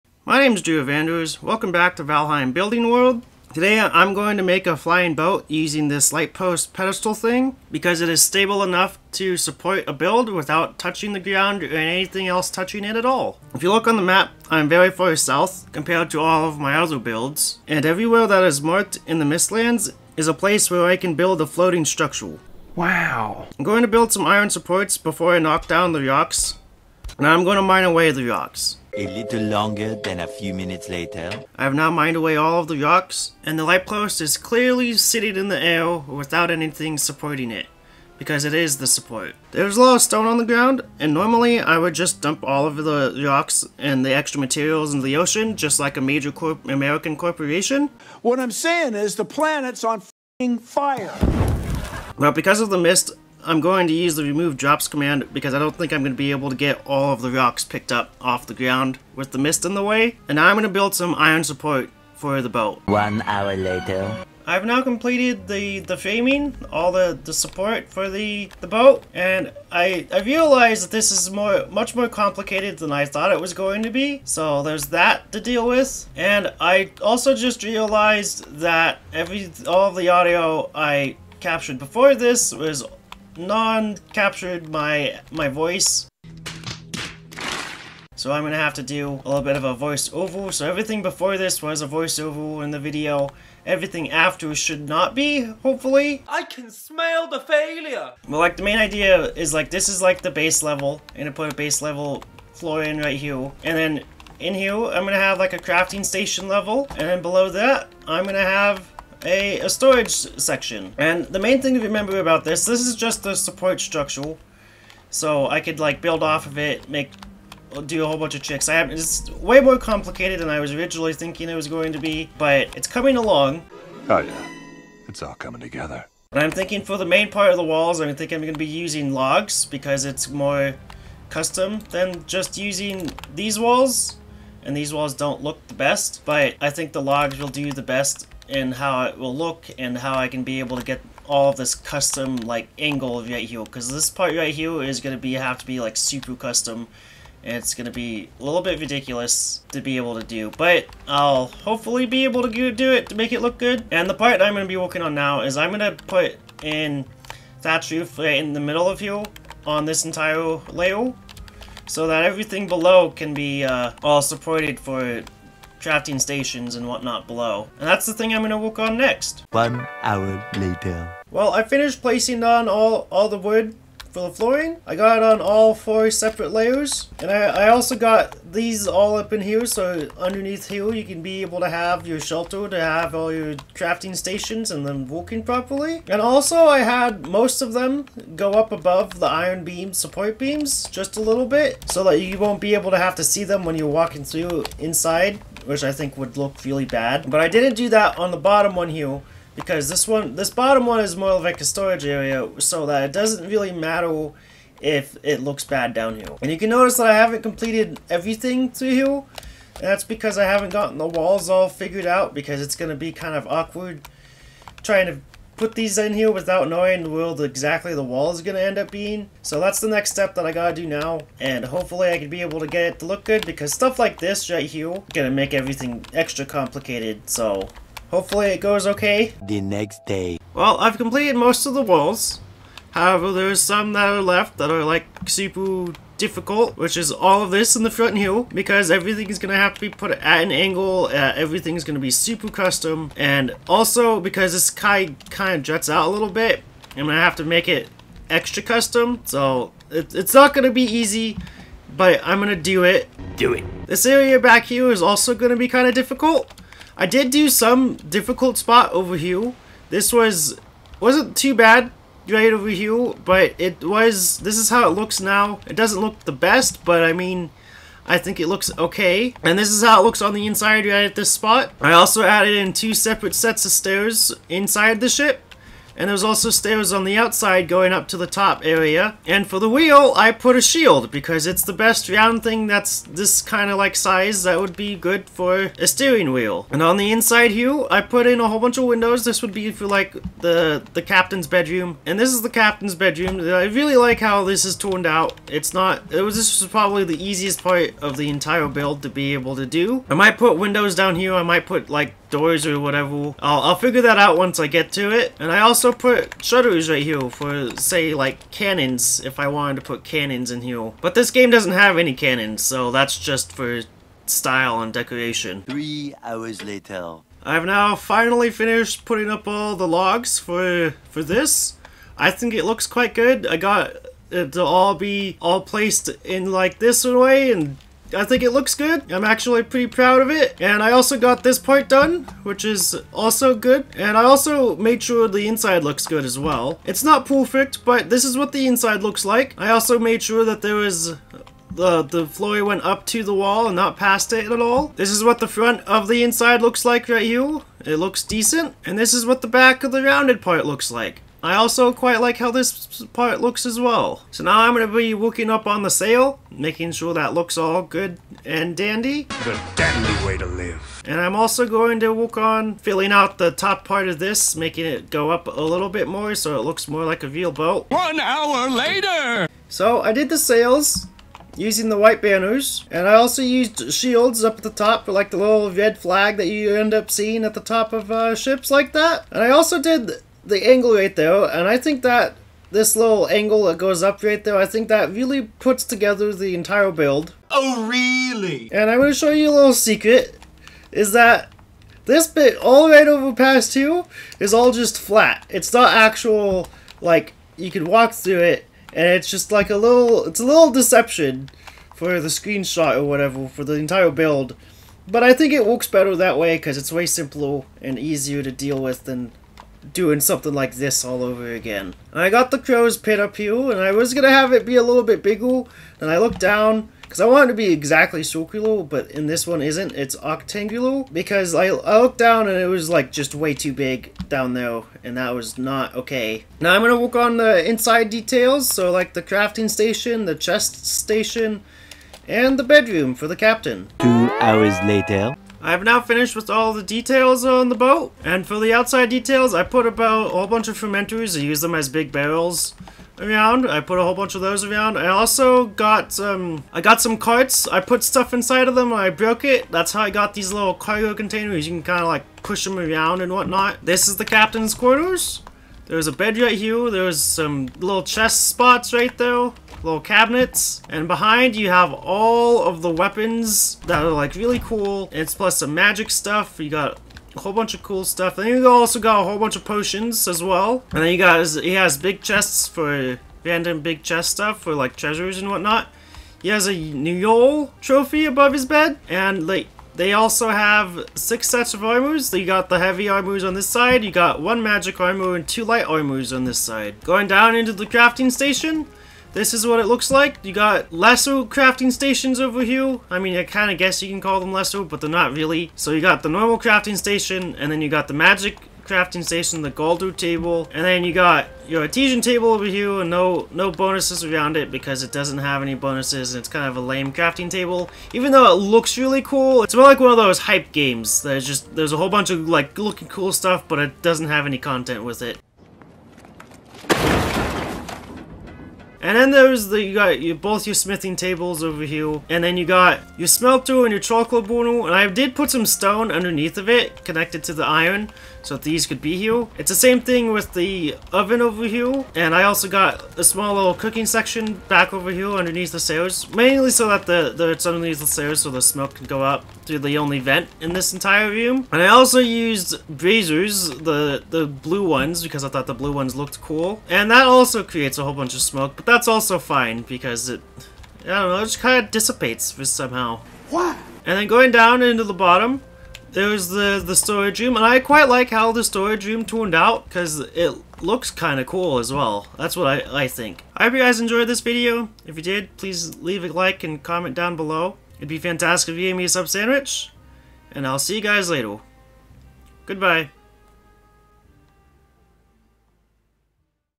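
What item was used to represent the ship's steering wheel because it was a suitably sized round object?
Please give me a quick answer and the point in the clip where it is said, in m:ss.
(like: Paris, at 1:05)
A shield, at 4:40.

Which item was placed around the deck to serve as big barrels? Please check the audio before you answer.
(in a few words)
Fermenters.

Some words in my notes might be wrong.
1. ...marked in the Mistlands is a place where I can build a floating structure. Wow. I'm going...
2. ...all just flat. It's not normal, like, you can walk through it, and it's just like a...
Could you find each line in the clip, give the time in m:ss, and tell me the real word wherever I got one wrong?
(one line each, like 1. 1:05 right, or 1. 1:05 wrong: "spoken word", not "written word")
1. 0:18 right
2. 6:34 wrong: "actual", not "normal".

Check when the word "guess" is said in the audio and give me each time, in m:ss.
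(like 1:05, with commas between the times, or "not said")
8:13.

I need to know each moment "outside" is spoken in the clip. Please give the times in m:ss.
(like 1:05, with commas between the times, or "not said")
4:37, 7:18.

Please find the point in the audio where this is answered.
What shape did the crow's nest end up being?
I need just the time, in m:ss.
7:00.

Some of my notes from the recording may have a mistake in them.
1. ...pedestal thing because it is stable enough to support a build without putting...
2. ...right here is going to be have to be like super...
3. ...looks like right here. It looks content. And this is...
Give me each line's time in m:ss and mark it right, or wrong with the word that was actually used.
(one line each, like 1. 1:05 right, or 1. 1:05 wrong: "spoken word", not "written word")
1. 0:06 wrong: "touching", not "putting"
2. 2:24 right
3. 5:46 wrong: "decent", not "content".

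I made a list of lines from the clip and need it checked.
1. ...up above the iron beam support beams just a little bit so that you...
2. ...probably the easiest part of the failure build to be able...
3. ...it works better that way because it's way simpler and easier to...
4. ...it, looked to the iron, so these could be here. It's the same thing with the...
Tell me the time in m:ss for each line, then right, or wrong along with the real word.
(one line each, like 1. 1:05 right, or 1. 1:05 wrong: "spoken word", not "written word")
1. 3:08 right
2. 4:56 wrong: "entire", not "failure"
3. 6:45 right
4. 8:46 wrong: "connected", not "looked".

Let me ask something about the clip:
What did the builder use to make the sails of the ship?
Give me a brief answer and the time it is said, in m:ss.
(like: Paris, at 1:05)
White banners, at 6:11.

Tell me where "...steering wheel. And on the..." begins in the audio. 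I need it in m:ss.
4:45.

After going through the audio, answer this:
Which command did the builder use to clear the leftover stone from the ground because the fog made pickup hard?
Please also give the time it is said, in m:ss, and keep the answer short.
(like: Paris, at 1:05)
remove drops, at 0:54.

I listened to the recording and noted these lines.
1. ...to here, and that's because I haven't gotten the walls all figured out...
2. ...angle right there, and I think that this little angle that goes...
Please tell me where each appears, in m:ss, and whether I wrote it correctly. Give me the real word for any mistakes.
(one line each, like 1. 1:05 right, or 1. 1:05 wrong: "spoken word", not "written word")
1. 3:28 right
2. 6:20 right.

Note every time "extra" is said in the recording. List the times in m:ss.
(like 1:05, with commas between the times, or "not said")
0:44, 3:46, 4:08.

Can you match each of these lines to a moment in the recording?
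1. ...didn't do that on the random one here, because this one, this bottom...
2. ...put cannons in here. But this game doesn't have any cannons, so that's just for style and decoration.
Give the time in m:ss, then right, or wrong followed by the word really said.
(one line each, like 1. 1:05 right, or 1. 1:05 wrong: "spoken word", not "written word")
1. 3:17 wrong: "bottom", not "random"
2. 5:09 right.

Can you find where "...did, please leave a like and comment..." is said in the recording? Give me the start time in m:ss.
9:25.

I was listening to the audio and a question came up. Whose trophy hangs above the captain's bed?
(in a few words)
Nyol.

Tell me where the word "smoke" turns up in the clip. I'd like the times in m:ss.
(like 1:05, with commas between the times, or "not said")
8:58, 9:08.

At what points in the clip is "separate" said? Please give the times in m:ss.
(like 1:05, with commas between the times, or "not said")
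2:56, 4:32.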